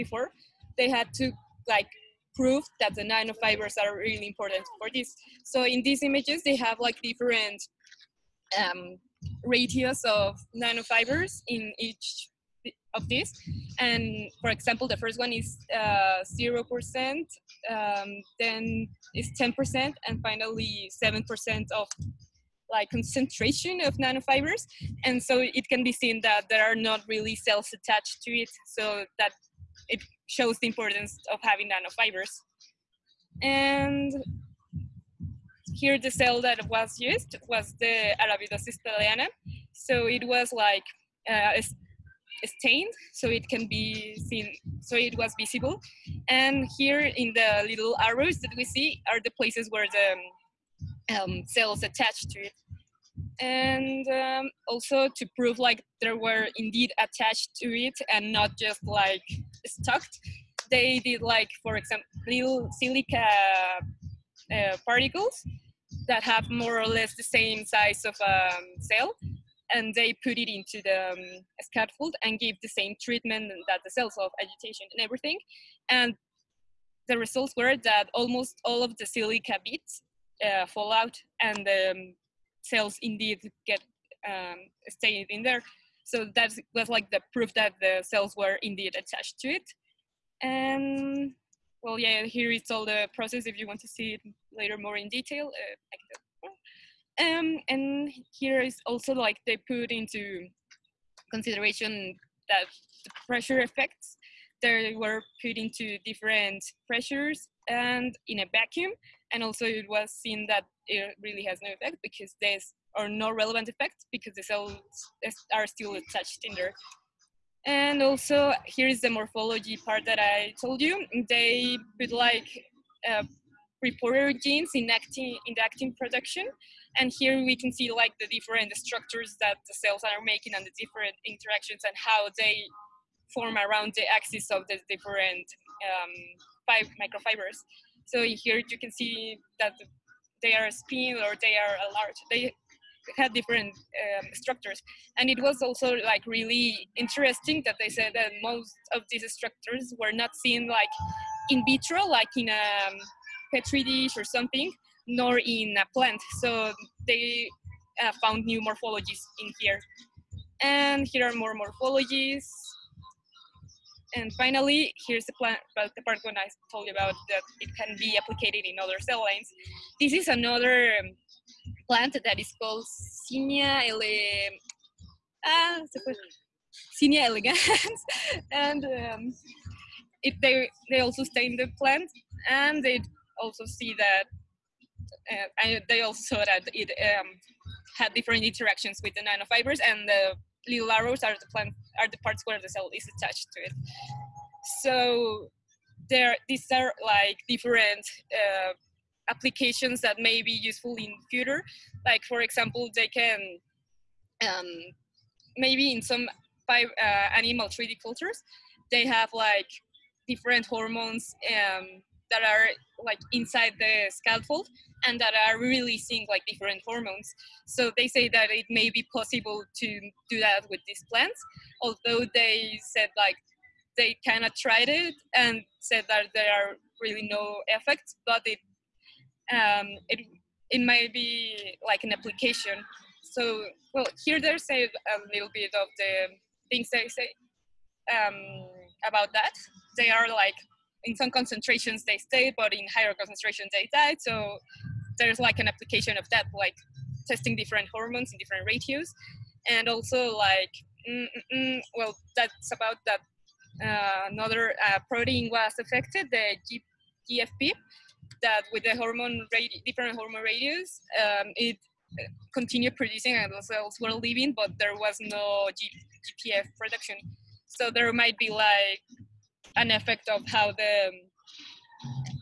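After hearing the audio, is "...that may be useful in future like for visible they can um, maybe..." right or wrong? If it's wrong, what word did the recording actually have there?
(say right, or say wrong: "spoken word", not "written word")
wrong: "example", not "visible".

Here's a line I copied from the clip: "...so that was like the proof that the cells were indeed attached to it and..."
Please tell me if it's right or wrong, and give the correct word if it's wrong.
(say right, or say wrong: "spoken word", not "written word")
right.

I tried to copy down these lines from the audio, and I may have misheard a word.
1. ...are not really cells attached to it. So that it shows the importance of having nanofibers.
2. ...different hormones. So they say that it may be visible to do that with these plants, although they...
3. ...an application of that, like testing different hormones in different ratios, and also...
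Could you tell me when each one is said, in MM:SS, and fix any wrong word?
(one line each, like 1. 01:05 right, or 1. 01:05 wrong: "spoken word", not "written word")
1. 00:26 right
2. 03:36 wrong: "possible", not "visible"
3. 04:05 right.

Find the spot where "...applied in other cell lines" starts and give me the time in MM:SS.
02:48.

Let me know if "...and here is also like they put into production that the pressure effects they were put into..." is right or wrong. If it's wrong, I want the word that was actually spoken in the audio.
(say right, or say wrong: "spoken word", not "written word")
wrong: "consideration", not "production".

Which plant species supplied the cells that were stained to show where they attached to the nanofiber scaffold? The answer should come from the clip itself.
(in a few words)
Arabidopsis thaliana.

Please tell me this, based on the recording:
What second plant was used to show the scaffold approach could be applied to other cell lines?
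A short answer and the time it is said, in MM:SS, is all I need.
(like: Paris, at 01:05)
Zinnia elegans, at 02:56.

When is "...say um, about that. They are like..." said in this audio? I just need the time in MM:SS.
03:57.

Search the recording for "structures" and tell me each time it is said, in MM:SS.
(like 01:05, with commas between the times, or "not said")
02:08, 02:24, 02:29.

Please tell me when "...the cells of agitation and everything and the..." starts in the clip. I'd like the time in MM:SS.
01:13.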